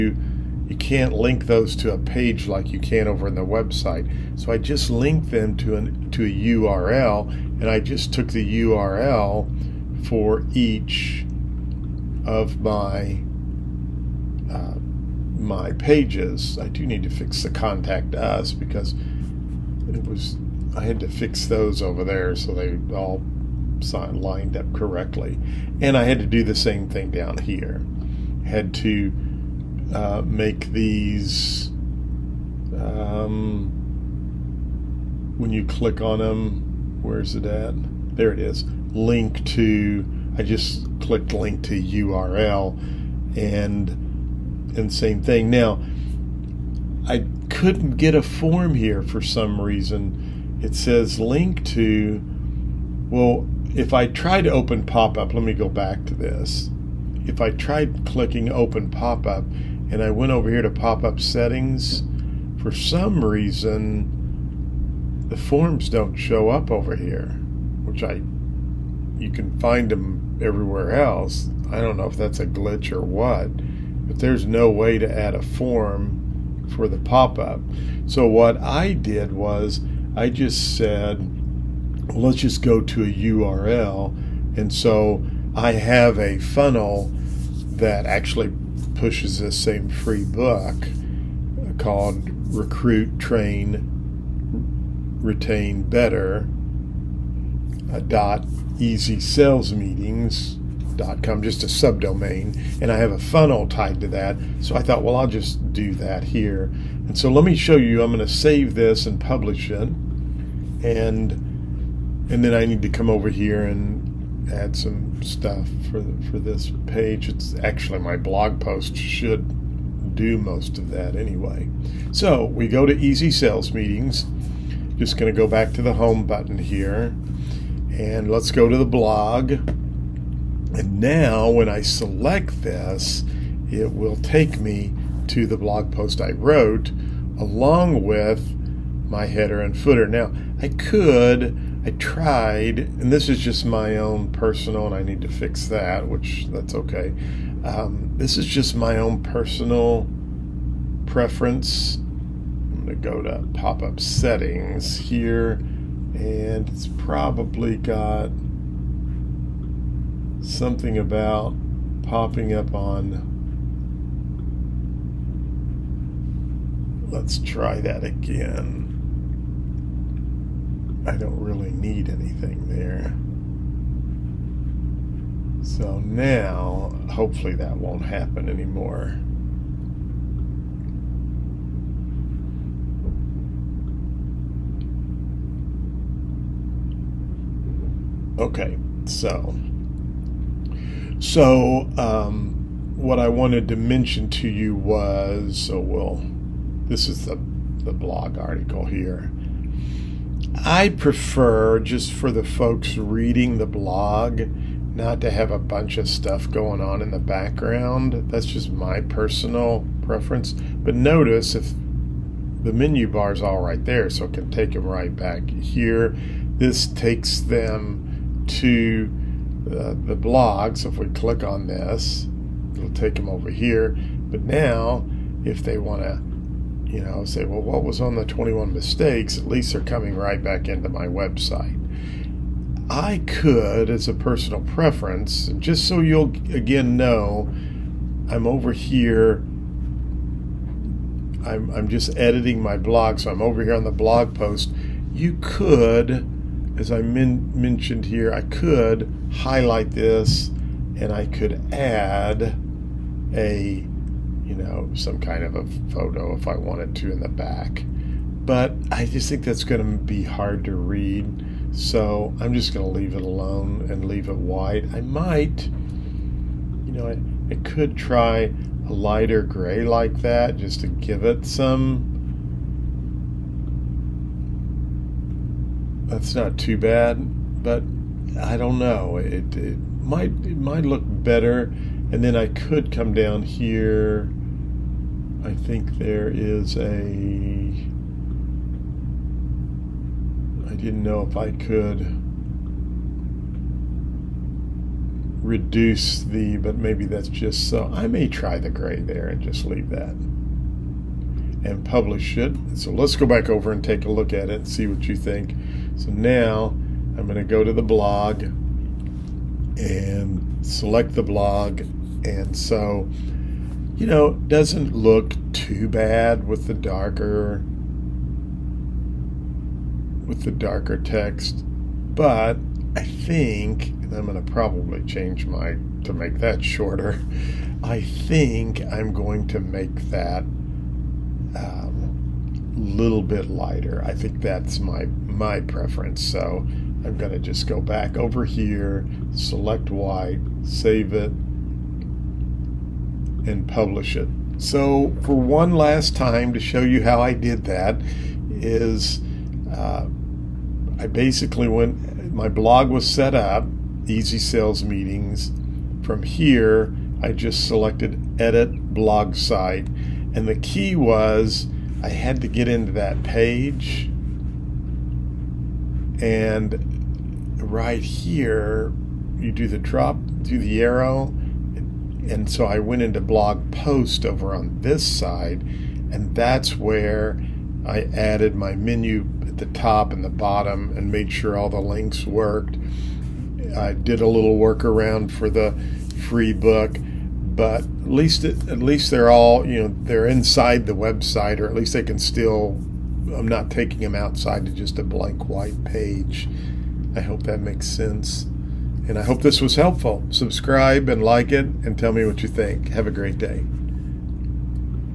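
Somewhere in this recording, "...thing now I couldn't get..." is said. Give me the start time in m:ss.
0:45.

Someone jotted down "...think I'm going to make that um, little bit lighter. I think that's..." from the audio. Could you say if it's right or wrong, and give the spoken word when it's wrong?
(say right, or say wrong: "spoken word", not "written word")
right.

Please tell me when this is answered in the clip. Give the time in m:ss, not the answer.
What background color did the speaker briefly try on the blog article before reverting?
4:28.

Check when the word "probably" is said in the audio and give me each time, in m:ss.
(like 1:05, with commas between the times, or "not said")
2:36, 5:24.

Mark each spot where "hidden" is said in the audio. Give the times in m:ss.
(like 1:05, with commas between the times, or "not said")
not said.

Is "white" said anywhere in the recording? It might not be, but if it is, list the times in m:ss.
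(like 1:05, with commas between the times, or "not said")
4:24, 5:39, 6:35.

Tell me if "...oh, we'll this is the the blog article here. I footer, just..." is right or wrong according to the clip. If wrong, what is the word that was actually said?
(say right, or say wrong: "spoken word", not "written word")
wrong: "prefer", not "footer".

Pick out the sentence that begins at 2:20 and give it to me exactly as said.
Now I could I tried, and this is just my own personal, and I need to fix that, which that's okay.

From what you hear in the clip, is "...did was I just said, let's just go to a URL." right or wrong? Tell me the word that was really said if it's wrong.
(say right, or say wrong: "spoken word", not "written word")
right.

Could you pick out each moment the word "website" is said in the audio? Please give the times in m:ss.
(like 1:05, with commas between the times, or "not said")
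0:03, 3:51, 6:30.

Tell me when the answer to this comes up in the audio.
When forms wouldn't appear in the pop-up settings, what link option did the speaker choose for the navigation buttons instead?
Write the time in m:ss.
0:41.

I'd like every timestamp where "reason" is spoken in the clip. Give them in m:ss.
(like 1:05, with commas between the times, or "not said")
0:49, 1:03.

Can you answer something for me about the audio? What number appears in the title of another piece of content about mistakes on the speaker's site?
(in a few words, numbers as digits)
21.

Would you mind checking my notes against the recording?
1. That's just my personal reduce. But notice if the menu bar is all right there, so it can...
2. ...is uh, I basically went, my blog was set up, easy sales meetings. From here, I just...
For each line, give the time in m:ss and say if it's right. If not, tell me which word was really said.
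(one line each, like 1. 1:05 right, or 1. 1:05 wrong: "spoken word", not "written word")
1. 3:28 wrong: "preference", not "reduce"
2. 5:48 right.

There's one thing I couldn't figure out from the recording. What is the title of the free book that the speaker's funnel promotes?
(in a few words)
Recruit, Train, Retain Better.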